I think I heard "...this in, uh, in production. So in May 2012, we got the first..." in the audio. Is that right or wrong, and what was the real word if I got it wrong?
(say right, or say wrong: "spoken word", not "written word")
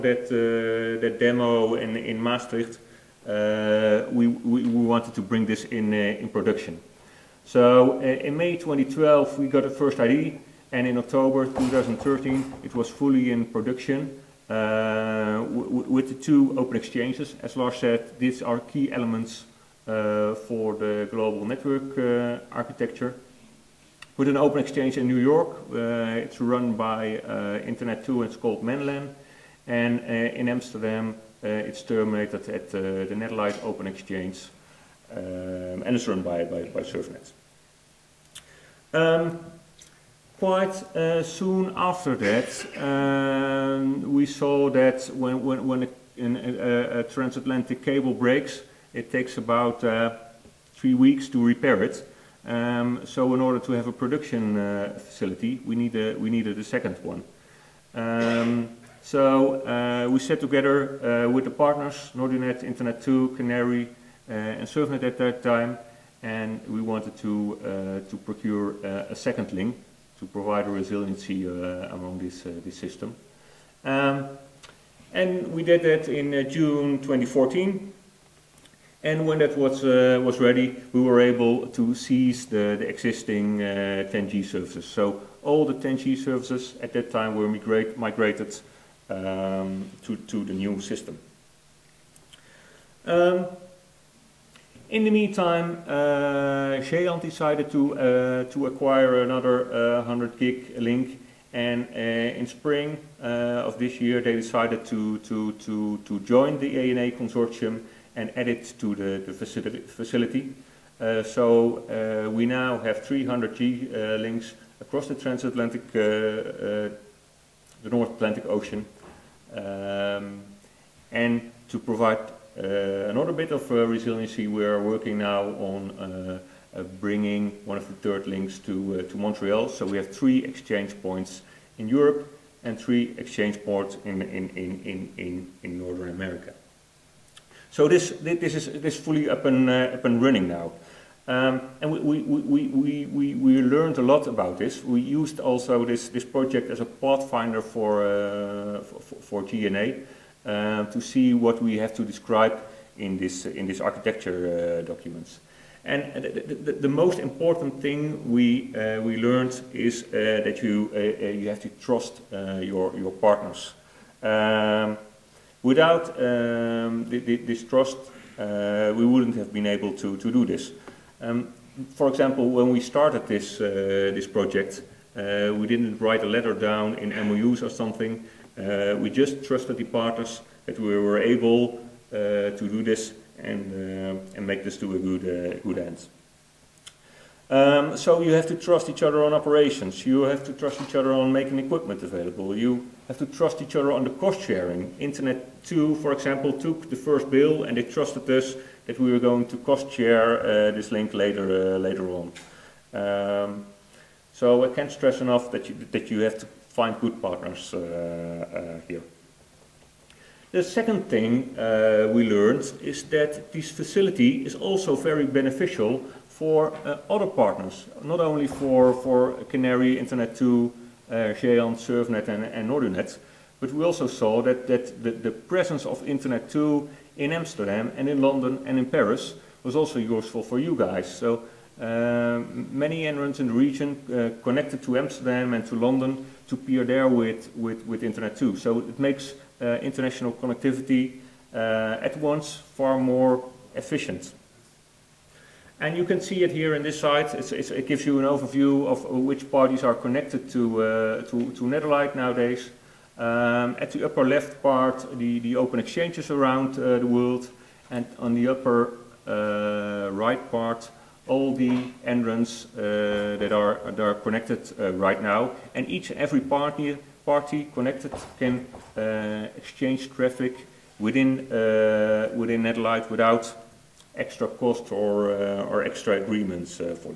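right.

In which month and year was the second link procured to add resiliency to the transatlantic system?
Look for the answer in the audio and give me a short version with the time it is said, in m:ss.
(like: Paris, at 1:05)
June 2014, at 1:16.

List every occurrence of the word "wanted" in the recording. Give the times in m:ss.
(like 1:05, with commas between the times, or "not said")
0:04, 1:06.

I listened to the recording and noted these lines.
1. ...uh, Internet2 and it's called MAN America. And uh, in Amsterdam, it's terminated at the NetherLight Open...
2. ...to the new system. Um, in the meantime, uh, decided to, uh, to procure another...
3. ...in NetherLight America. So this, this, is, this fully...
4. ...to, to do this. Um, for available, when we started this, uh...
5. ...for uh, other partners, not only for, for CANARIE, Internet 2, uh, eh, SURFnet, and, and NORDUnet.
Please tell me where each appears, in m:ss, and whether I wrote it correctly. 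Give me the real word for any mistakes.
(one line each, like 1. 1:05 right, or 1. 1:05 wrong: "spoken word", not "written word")
1. 0:27 wrong: "LAN", not "America"
2. 1:30 wrong: "acquire", not "procure"
3. 2:15 wrong: "Northern", not "NetherLight"
4. 2:49 wrong: "example", not "available"
5. 3:36 right.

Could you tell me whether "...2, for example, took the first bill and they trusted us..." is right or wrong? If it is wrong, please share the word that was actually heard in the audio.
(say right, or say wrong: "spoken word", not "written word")
right.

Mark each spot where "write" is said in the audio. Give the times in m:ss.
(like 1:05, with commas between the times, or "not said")
2:55.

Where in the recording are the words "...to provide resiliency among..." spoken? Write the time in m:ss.
1:10.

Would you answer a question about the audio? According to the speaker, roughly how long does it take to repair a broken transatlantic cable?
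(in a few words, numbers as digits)
3 weeks.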